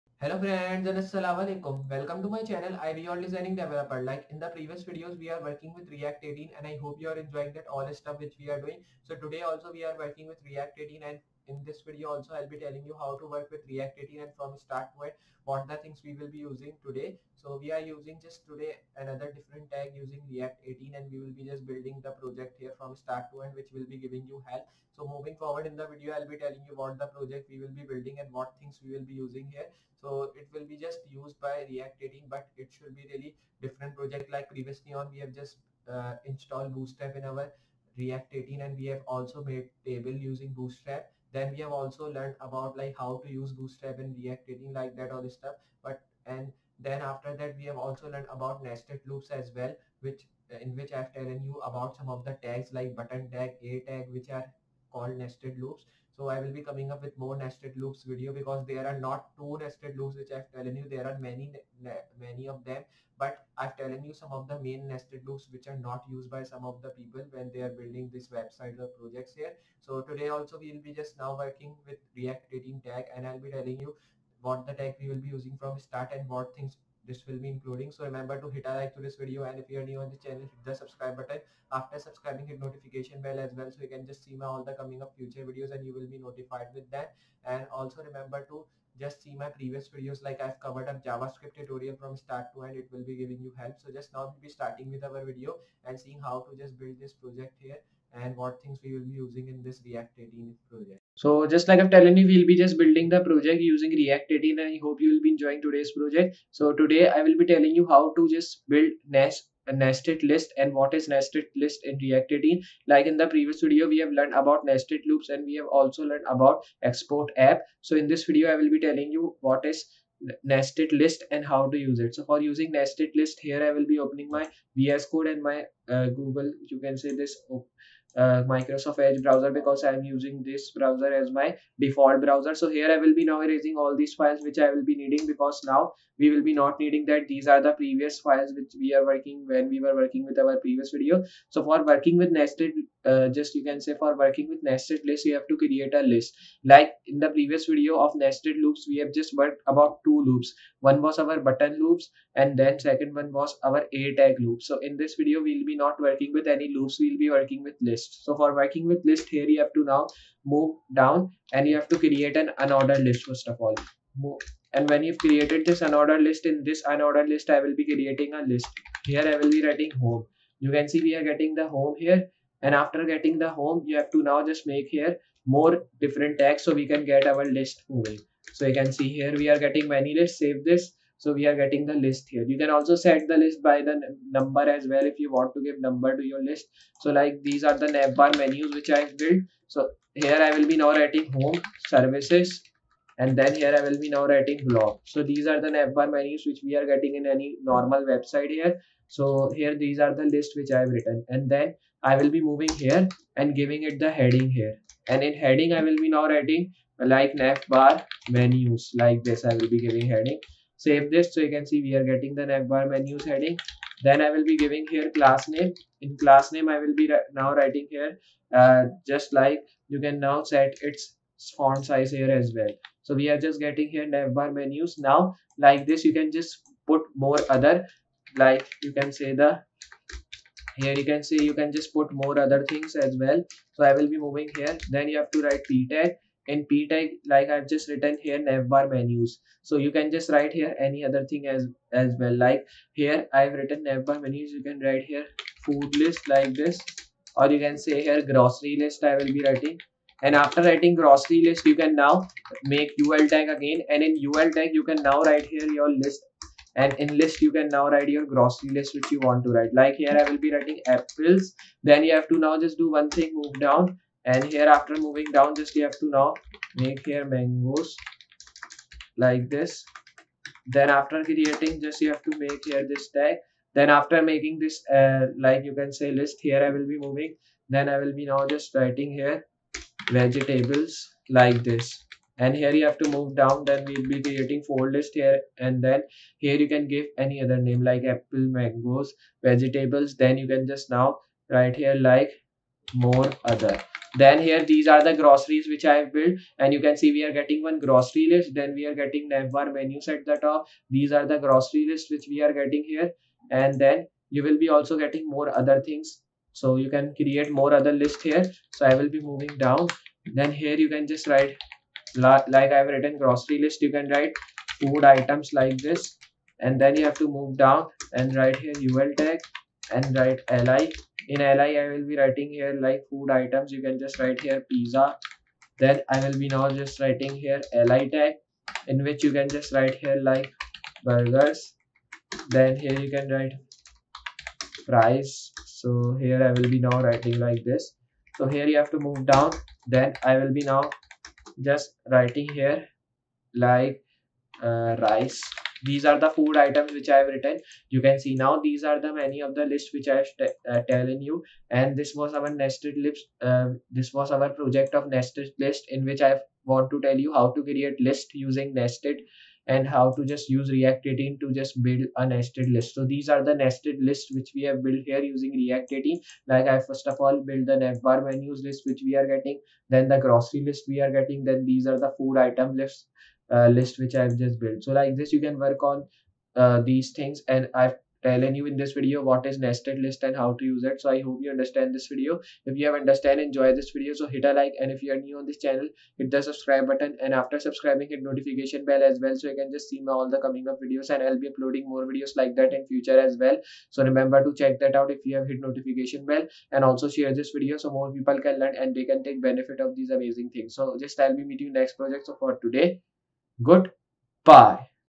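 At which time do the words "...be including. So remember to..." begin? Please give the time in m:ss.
1:17.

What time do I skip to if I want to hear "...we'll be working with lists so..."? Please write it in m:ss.
2:37.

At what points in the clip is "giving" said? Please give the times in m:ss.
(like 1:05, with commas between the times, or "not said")
0:23, 1:33, 3:23, 3:29, 3:34.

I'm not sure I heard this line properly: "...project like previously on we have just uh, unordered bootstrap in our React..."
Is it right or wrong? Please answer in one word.
wrong.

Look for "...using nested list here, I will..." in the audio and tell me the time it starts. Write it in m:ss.
2:02.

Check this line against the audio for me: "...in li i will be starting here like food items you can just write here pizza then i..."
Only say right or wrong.
wrong.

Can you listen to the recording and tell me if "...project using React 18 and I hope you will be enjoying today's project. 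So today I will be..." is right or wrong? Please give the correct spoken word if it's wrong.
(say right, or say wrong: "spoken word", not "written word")
right.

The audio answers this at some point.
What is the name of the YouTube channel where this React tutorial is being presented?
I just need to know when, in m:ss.
0:02.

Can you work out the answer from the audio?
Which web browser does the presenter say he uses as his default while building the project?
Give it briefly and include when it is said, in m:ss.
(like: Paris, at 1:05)
Microsoft Edge, at 2:08.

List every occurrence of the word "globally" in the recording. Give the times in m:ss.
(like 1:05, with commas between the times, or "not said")
not said.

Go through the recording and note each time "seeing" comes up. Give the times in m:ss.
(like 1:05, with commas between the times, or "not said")
1:35.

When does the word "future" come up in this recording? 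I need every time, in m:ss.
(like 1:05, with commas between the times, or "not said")
1:25, 6:32.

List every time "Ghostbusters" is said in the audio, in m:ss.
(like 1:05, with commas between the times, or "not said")
not said.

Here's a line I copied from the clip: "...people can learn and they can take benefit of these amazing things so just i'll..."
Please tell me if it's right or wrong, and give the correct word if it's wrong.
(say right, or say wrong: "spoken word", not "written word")
right.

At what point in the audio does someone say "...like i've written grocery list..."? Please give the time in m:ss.
5:12.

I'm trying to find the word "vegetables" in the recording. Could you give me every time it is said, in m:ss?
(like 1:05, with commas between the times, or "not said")
4:40, 4:49.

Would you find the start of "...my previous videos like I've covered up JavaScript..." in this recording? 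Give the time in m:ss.
1:29.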